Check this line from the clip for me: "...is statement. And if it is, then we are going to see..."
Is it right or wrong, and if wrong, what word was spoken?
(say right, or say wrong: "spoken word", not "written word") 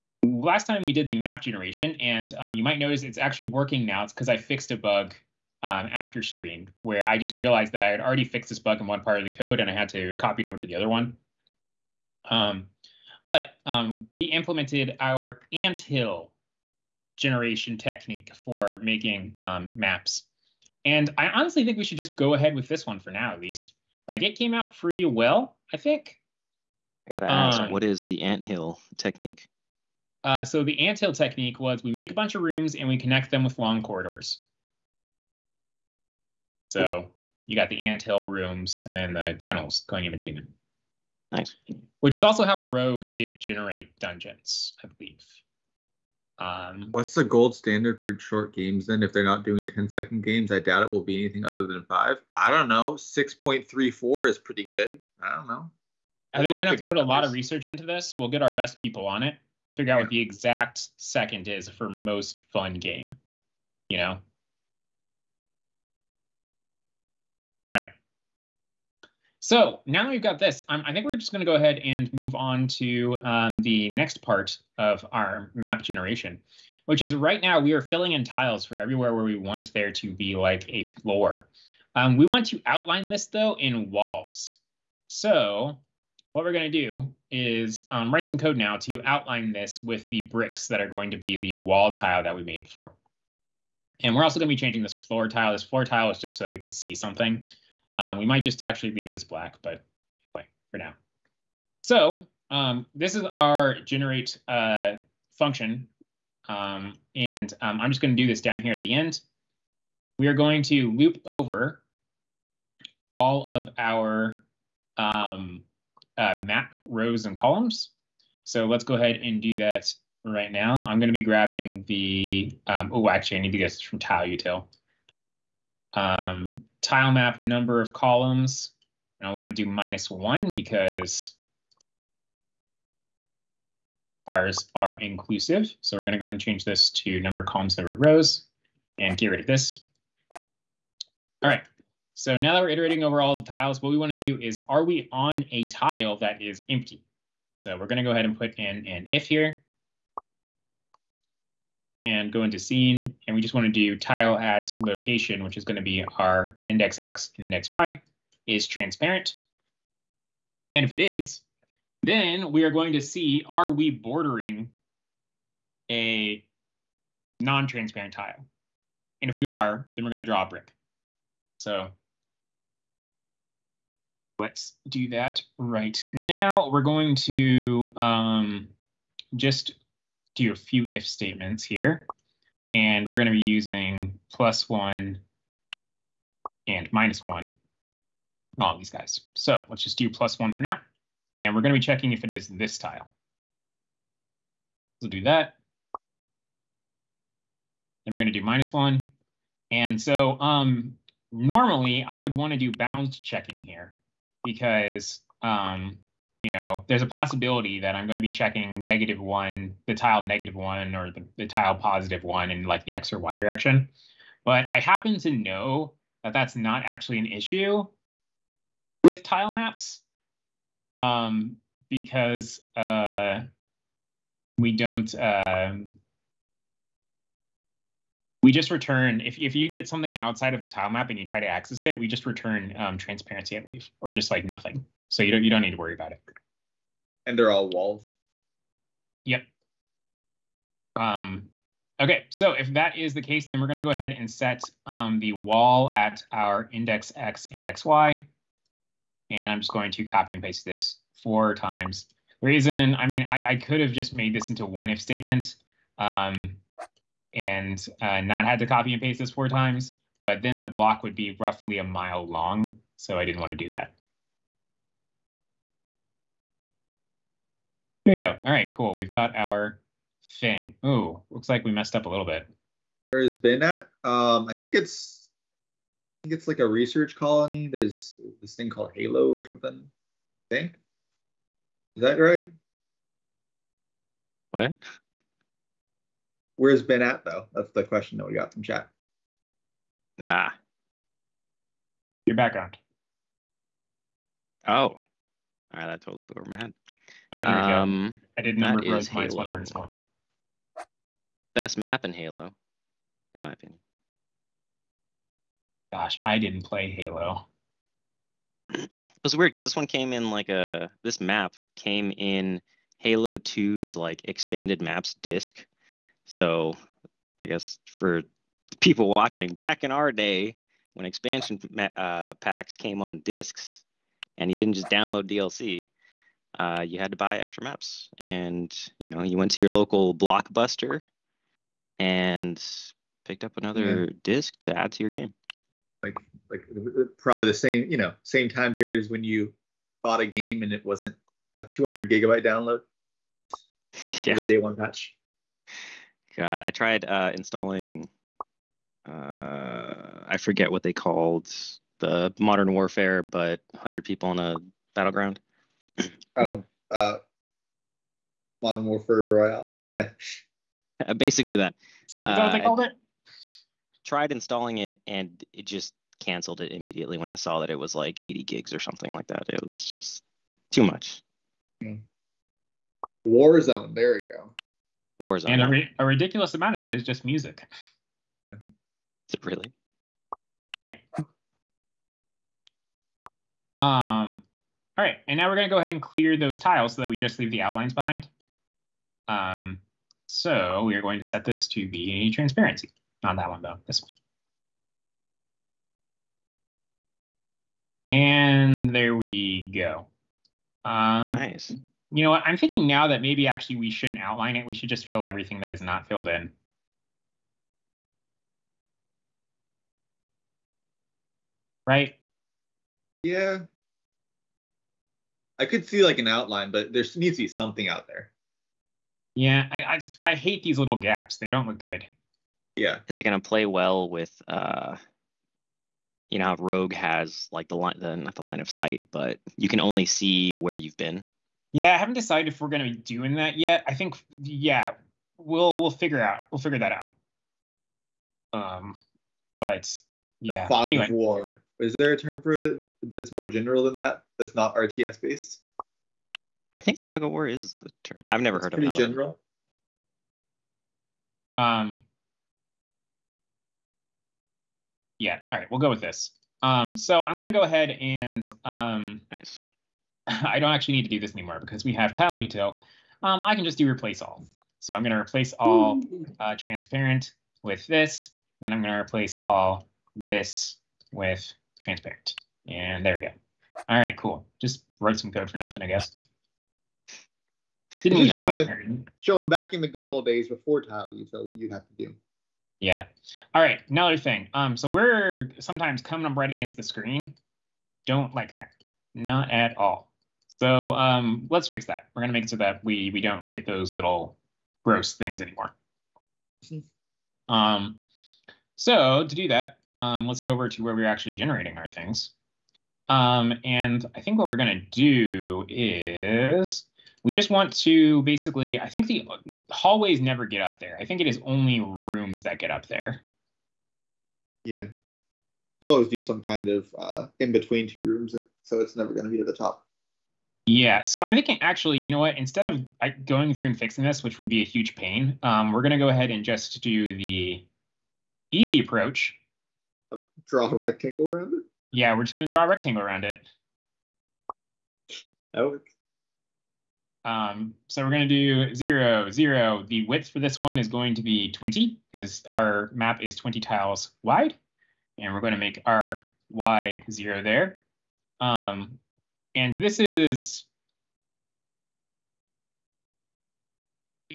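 wrong: "transparent", not "statement".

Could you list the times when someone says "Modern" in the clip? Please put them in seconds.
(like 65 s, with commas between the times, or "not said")
352 s, 358 s.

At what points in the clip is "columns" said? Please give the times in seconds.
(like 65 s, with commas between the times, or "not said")
117 s, 127 s, 137 s.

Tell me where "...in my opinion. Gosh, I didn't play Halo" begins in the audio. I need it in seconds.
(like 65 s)
303 s.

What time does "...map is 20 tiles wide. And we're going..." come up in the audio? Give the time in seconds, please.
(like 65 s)
542 s.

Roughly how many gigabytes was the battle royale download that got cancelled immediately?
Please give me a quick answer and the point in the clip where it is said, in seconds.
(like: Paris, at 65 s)
80, at 368 s.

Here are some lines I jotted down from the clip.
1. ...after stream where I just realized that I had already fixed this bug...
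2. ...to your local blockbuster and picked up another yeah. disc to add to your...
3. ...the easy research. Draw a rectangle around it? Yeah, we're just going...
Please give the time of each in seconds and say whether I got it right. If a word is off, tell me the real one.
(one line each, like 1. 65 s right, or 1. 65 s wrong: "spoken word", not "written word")
1. 5 s right
2. 329 s right
3. 527 s wrong: "approach", not "research".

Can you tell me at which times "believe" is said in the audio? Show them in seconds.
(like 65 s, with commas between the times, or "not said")
44 s, 233 s.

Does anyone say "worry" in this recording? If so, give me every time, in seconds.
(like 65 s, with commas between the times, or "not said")
235 s.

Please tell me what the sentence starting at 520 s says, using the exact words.
Yeah, so I'm thinking actually, you know what?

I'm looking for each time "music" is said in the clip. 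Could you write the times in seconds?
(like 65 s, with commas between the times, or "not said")
377 s.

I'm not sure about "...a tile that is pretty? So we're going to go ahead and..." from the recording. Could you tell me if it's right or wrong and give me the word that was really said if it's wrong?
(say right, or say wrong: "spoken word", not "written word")
wrong: "empty", not "pretty".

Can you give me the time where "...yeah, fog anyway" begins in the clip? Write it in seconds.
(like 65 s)
440 s.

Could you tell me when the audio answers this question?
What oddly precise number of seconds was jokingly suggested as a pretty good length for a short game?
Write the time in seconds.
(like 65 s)
52 s.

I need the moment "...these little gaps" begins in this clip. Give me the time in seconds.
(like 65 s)
420 s.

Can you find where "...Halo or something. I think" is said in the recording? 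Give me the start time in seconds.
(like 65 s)
278 s.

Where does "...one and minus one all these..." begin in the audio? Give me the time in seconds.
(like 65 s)
184 s.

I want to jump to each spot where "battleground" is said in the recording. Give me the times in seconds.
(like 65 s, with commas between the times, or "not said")
354 s.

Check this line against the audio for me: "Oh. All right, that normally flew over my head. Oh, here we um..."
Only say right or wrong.
wrong.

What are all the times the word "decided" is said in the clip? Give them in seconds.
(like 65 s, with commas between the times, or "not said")
432 s.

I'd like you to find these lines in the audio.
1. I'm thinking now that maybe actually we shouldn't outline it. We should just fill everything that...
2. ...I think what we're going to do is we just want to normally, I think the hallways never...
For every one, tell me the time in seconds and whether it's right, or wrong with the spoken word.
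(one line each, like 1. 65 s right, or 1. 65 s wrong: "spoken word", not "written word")
1. 402 s right
2. 504 s wrong: "basically", not "normally".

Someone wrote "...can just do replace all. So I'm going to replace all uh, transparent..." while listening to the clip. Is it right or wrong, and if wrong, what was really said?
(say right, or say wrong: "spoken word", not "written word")
right.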